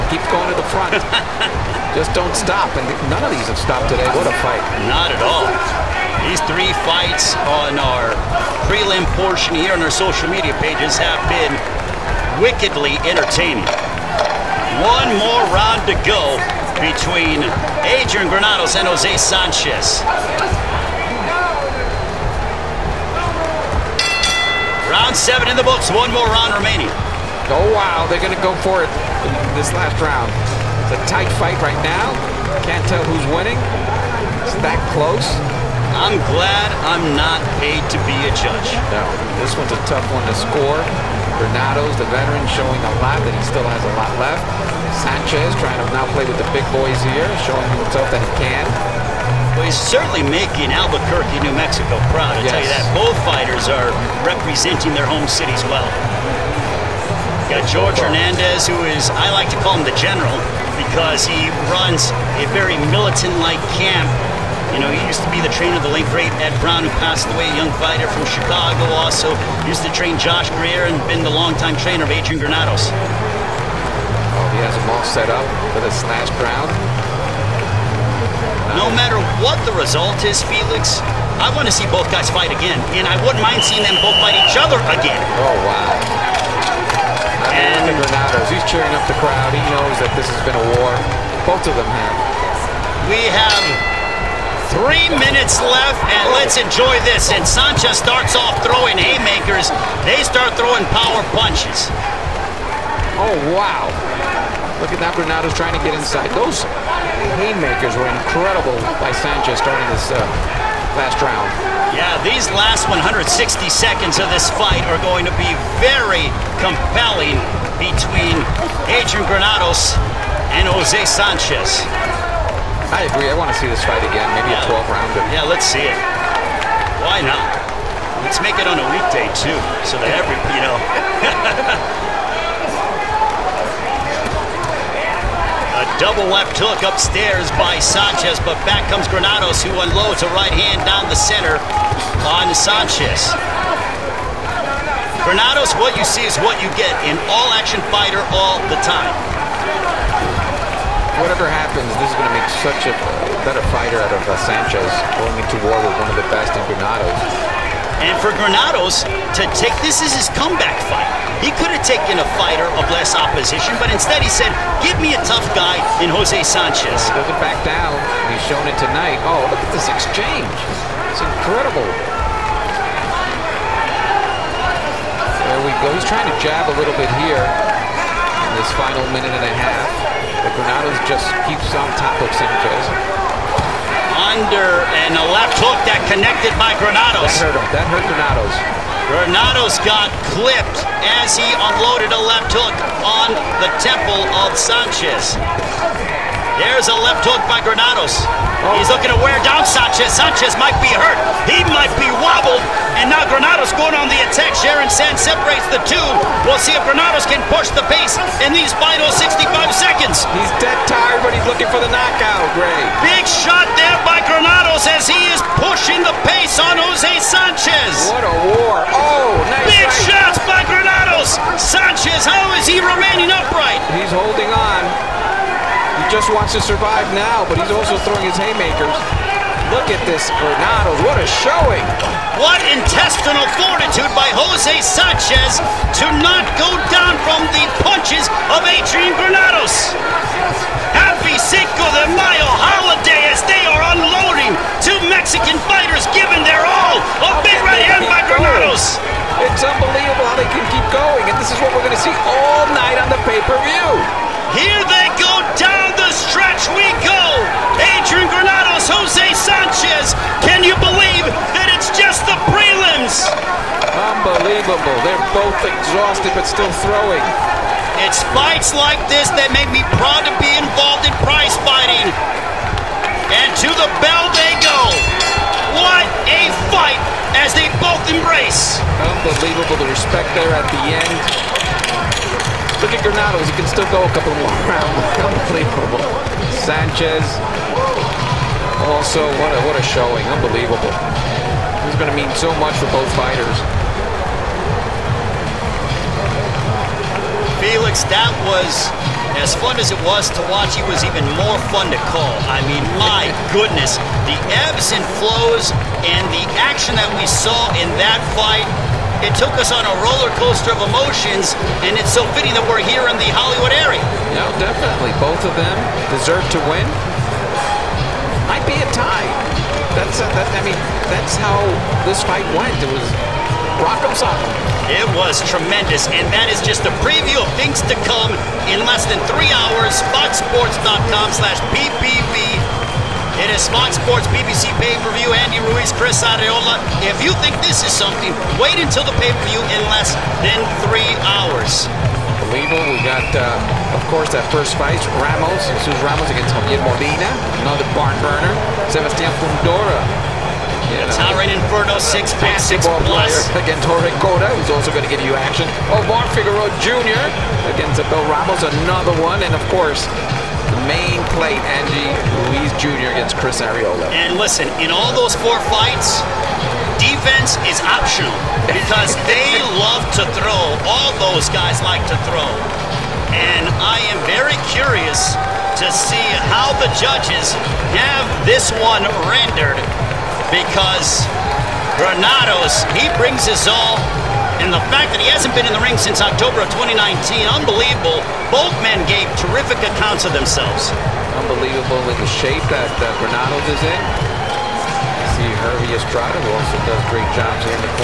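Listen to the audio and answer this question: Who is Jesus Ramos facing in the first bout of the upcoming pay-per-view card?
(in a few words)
Javier Molina.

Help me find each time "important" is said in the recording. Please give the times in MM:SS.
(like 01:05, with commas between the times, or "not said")
not said.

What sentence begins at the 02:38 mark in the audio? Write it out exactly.
And for Granados to take this as his comeback fight.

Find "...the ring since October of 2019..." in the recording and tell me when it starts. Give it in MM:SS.
06:25.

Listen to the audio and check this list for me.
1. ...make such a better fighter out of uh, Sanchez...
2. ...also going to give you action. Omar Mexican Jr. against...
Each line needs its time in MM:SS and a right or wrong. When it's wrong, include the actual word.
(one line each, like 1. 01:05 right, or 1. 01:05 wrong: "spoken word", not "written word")
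1. 02:32 right
2. 05:54 wrong: "Figueroa", not "Mexican".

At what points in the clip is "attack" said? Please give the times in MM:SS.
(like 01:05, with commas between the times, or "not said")
03:24.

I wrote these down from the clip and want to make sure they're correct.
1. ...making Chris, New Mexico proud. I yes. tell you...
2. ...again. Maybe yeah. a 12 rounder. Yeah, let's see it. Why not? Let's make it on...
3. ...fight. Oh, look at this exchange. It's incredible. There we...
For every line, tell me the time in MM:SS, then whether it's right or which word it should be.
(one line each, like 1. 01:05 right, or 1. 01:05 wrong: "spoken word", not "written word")
1. 00:50 wrong: "Albuquerque", not "Chris"
2. 02:04 right
3. 02:48 wrong: "tonight", not "fight".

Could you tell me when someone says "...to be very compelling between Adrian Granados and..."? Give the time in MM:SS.
01:55.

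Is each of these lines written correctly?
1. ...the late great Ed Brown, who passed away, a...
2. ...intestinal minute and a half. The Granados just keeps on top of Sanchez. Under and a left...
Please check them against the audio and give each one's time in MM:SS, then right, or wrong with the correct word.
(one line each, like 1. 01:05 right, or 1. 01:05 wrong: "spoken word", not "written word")
1. 01:05 right
2. 02:58 wrong: "final", not "intestinal".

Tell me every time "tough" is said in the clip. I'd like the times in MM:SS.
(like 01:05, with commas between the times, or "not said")
00:39, 02:45.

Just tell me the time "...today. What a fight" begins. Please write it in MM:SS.
00:03.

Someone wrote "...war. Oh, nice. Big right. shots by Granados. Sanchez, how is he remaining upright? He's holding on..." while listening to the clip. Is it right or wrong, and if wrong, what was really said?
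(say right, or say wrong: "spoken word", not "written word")
right.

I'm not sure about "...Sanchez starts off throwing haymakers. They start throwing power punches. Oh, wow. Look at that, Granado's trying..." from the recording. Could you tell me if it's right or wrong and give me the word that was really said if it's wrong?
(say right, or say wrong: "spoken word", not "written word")
right.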